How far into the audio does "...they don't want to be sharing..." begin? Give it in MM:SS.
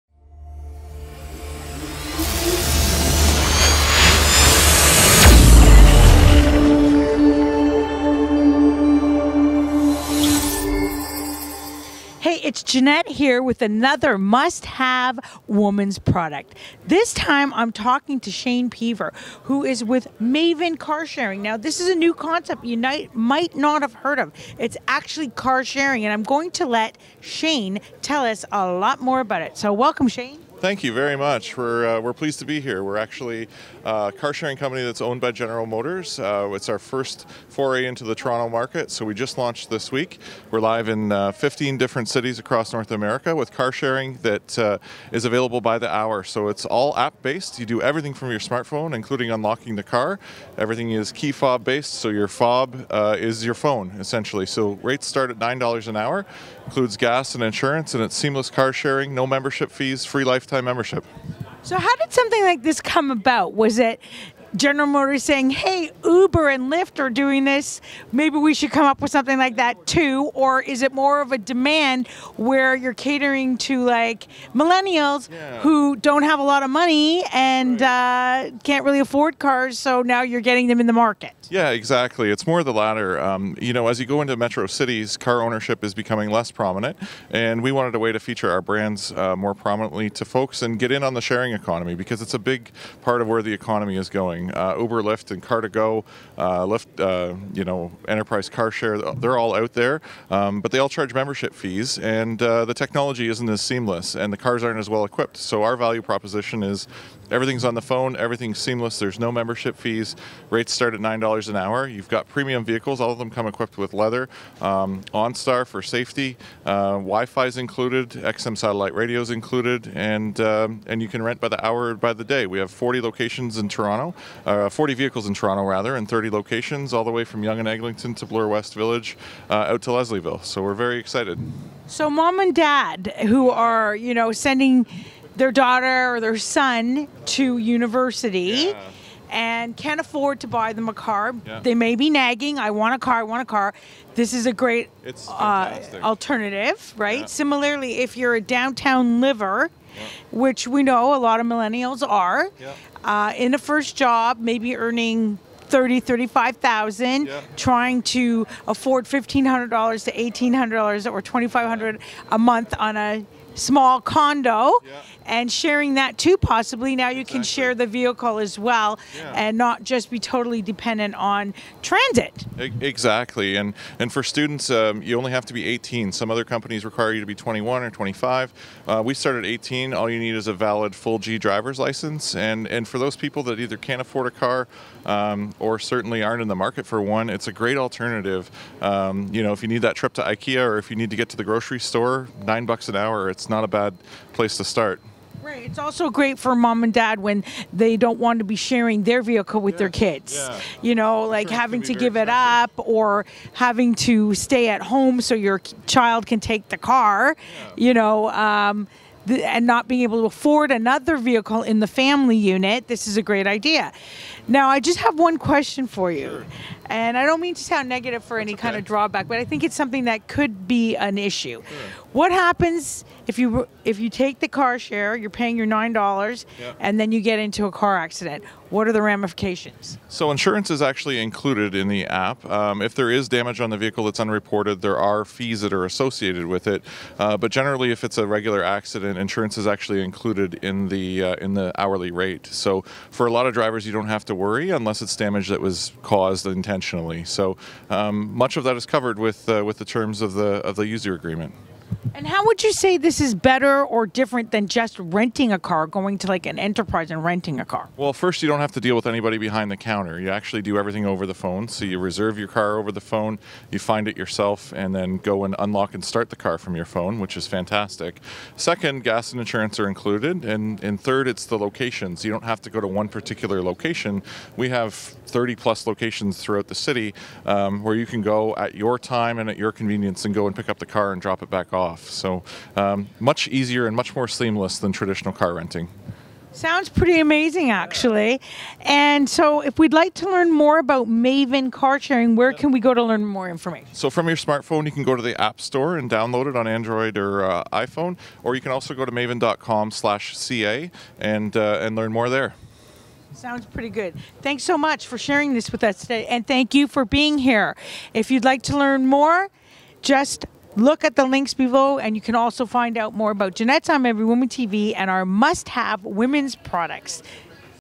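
03:17.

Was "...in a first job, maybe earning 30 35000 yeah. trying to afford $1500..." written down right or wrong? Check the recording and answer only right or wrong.
right.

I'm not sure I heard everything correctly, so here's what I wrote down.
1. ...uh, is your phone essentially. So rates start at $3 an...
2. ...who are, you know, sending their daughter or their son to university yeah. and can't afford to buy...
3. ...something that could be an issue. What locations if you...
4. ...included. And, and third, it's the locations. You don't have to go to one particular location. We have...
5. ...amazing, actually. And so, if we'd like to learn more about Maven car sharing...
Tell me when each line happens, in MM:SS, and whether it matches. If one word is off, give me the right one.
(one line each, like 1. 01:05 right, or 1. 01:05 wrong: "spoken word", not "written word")
1. 00:52 wrong: "9", not "3"
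2. 02:13 right
3. 03:39 wrong: "happens", not "locations"
4. 04:29 right
5. 04:47 right.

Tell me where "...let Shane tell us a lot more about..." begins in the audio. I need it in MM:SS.
00:26.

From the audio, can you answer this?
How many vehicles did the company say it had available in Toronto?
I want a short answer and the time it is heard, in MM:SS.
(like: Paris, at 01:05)
40, at 02:04.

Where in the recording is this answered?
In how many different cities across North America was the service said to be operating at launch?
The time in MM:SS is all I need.
00:41.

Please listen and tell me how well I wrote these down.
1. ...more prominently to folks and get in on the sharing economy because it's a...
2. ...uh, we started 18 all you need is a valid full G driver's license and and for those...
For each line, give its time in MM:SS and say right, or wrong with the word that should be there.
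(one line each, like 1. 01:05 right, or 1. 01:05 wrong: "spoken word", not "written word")
1. 01:29 right
2. 02:58 right.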